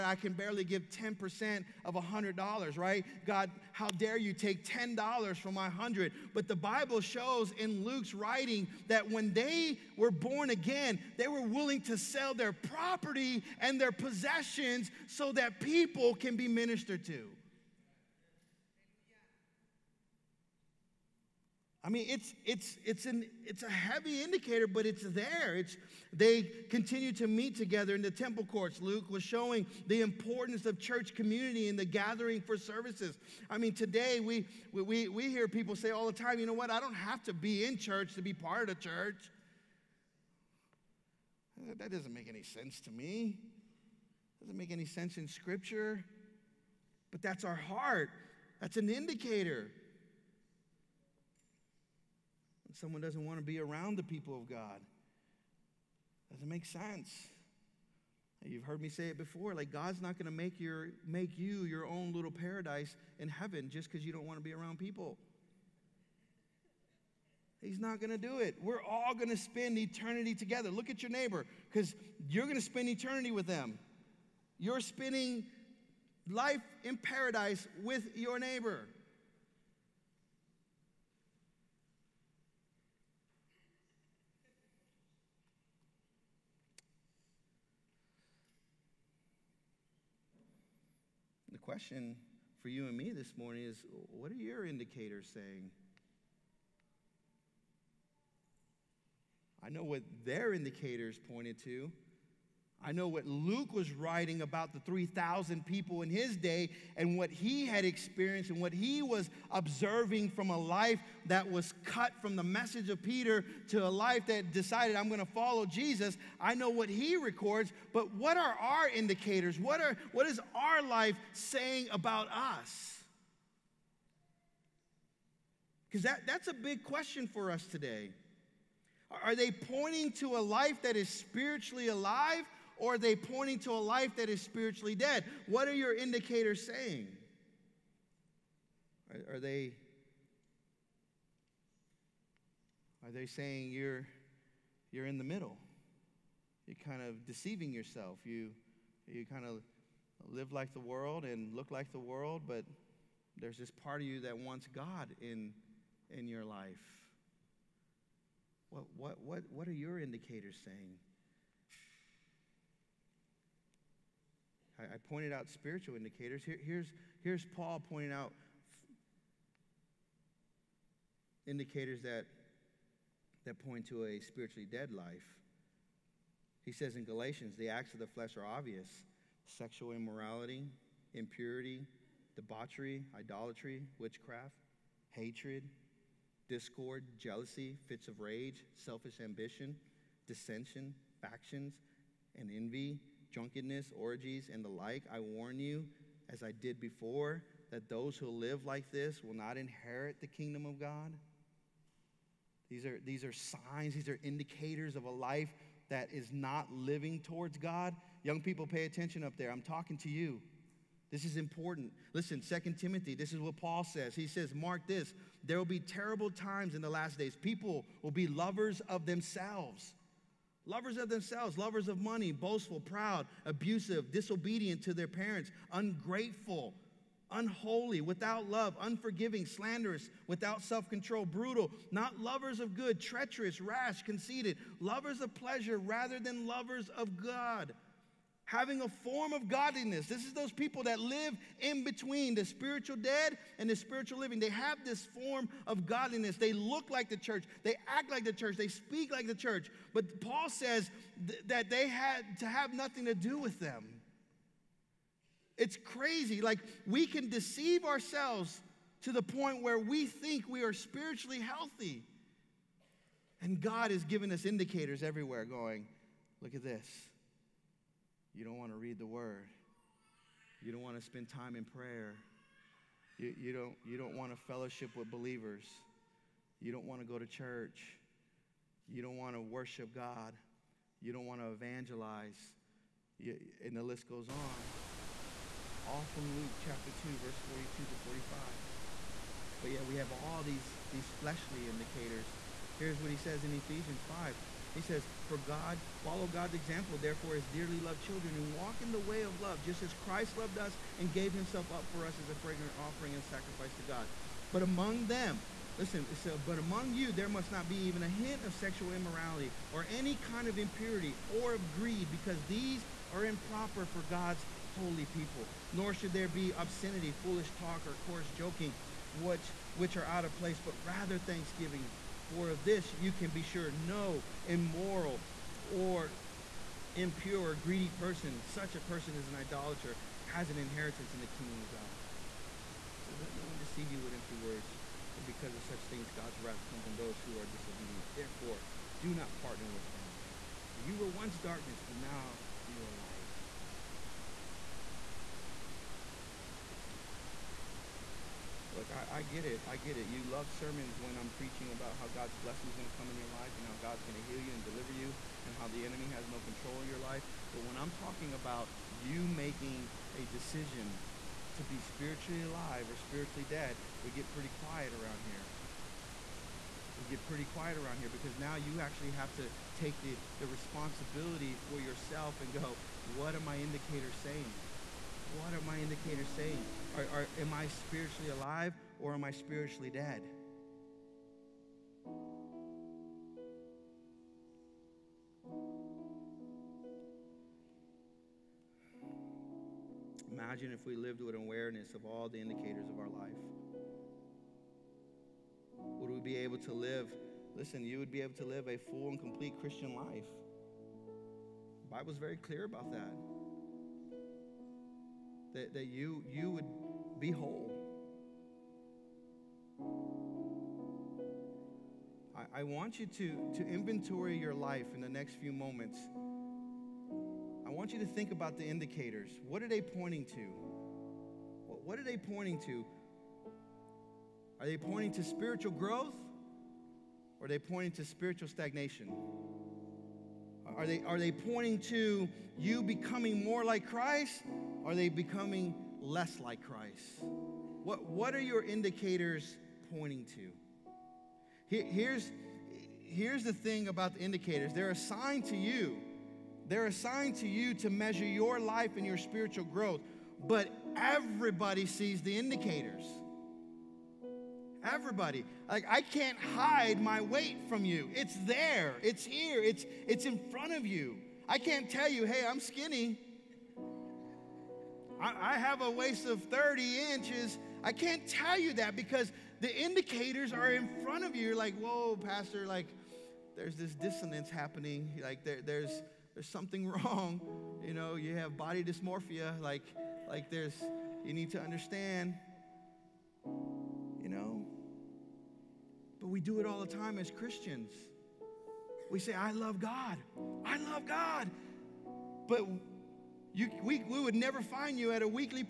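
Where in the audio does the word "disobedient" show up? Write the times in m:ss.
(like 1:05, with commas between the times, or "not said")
3:44, 5:37.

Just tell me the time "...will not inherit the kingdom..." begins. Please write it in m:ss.
3:19.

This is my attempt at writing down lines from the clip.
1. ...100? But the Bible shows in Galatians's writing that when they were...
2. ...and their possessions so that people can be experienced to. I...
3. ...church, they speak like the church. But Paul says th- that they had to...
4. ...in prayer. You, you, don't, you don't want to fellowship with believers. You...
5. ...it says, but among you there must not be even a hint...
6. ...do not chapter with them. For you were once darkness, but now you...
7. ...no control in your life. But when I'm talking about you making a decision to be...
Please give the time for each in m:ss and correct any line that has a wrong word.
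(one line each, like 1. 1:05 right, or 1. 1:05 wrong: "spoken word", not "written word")
1. 0:05 wrong: "Luke", not "Galatians"
2. 0:13 wrong: "ministered", not "experienced"
3. 4:08 right
4. 4:31 right
5. 5:06 right
6. 5:39 wrong: "partner", not "chapter"
7. 5:56 right.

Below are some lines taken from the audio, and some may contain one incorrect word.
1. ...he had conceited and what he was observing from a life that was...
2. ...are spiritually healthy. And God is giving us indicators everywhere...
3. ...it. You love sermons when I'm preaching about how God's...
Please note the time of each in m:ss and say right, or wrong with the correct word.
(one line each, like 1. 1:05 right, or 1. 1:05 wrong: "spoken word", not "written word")
1. 1:47 wrong: "experienced", not "conceited"
2. 4:20 right
3. 5:49 right.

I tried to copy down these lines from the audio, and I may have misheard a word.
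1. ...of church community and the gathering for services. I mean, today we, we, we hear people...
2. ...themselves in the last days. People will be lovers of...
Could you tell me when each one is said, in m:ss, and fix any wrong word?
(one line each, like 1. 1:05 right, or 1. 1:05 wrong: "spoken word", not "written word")
1. 0:30 right
2. 3:36 wrong: "times", not "themselves".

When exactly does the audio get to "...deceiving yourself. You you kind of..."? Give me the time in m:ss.
2:27.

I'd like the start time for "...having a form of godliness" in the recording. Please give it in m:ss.
3:58.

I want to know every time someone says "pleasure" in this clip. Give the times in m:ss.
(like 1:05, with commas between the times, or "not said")
3:55.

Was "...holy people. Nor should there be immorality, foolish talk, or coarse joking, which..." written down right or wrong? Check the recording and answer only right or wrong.
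wrong.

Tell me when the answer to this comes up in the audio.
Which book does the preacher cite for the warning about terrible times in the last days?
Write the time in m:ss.
3:32.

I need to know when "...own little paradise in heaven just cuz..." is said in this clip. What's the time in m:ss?
1:01.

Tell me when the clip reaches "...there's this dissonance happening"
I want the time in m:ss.
7:53.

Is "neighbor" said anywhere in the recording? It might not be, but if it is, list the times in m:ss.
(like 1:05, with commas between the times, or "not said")
1:11, 1:18.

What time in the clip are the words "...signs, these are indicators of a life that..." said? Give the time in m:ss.
3:23.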